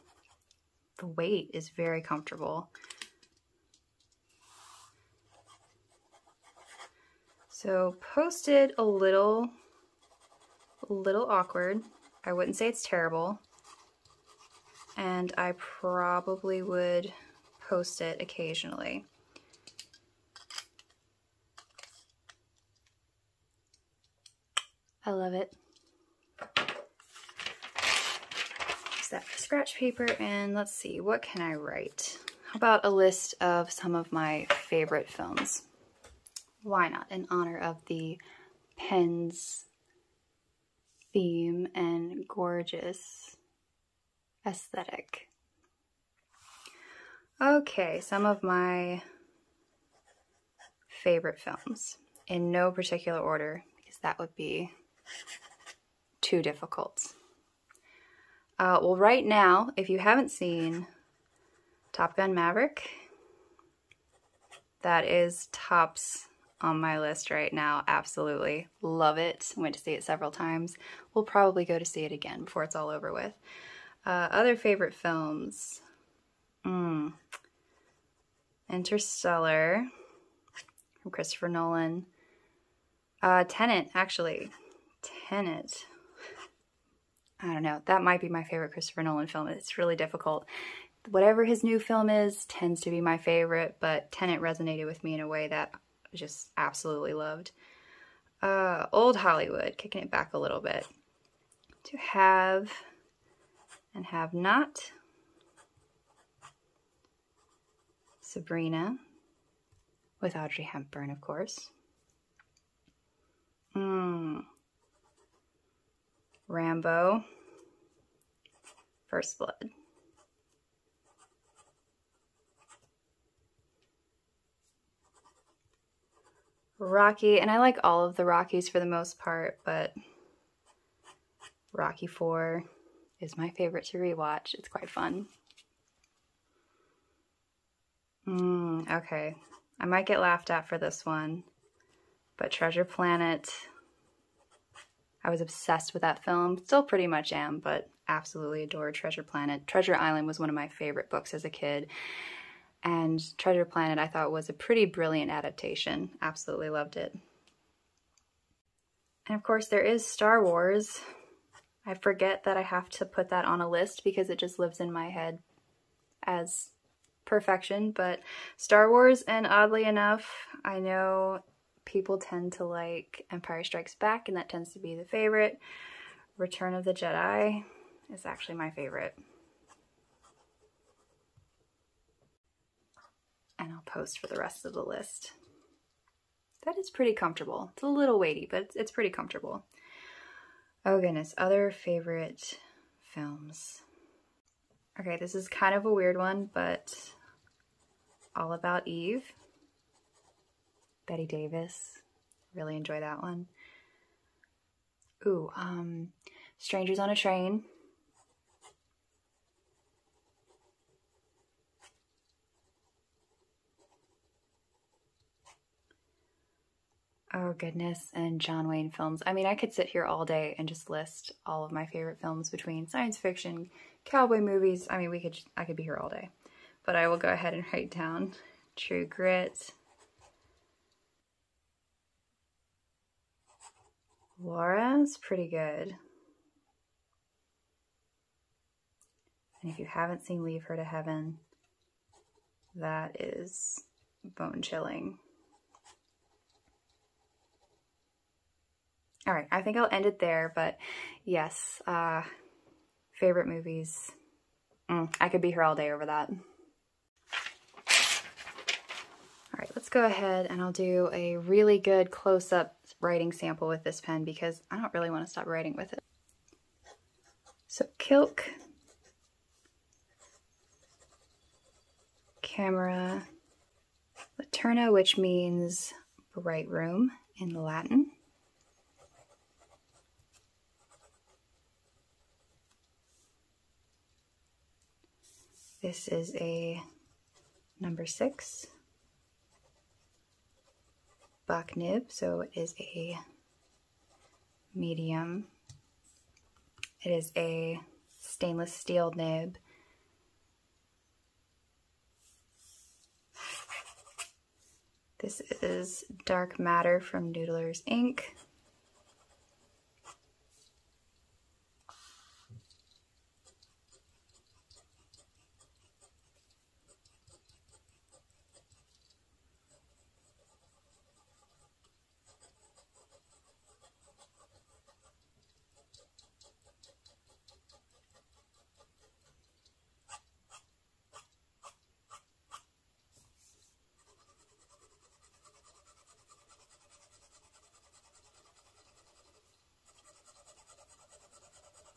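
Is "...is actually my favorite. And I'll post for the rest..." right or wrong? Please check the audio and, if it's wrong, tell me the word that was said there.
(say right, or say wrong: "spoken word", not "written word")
right.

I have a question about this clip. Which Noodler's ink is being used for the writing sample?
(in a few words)
Dark Matter.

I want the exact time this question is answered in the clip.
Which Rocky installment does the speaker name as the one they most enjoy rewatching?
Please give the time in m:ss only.
2:11.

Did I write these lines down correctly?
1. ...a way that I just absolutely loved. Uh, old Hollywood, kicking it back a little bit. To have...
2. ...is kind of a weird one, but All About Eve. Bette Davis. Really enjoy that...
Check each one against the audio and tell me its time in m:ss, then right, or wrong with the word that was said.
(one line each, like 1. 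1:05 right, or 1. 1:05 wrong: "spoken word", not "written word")
1. 1:35 right
2. 3:15 right.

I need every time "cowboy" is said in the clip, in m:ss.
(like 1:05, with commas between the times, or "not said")
3:44.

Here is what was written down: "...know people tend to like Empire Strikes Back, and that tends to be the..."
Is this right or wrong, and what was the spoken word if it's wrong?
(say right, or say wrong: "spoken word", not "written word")
right.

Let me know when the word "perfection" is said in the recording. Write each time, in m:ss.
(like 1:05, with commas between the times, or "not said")
2:47.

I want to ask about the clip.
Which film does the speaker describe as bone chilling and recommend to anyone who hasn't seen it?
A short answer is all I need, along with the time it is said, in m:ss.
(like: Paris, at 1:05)
Leave Her to Heaven, at 4:00.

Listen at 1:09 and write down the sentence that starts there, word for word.
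Went to see it several times.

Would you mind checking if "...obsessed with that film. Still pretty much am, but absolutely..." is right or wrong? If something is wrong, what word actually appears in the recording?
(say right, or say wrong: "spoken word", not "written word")
right.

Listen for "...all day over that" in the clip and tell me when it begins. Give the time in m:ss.
4:15.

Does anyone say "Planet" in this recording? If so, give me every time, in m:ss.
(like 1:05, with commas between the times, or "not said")
2:22, 2:29, 2:33.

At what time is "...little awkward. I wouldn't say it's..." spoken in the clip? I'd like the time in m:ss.
0:10.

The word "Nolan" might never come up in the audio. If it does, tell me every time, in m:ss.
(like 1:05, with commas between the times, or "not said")
1:21, 1:29.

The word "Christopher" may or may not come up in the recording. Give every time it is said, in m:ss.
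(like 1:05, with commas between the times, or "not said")
1:21, 1:28.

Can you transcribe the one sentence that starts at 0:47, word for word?
Okay, some of my favorite films in no particular order because that would be too difficult.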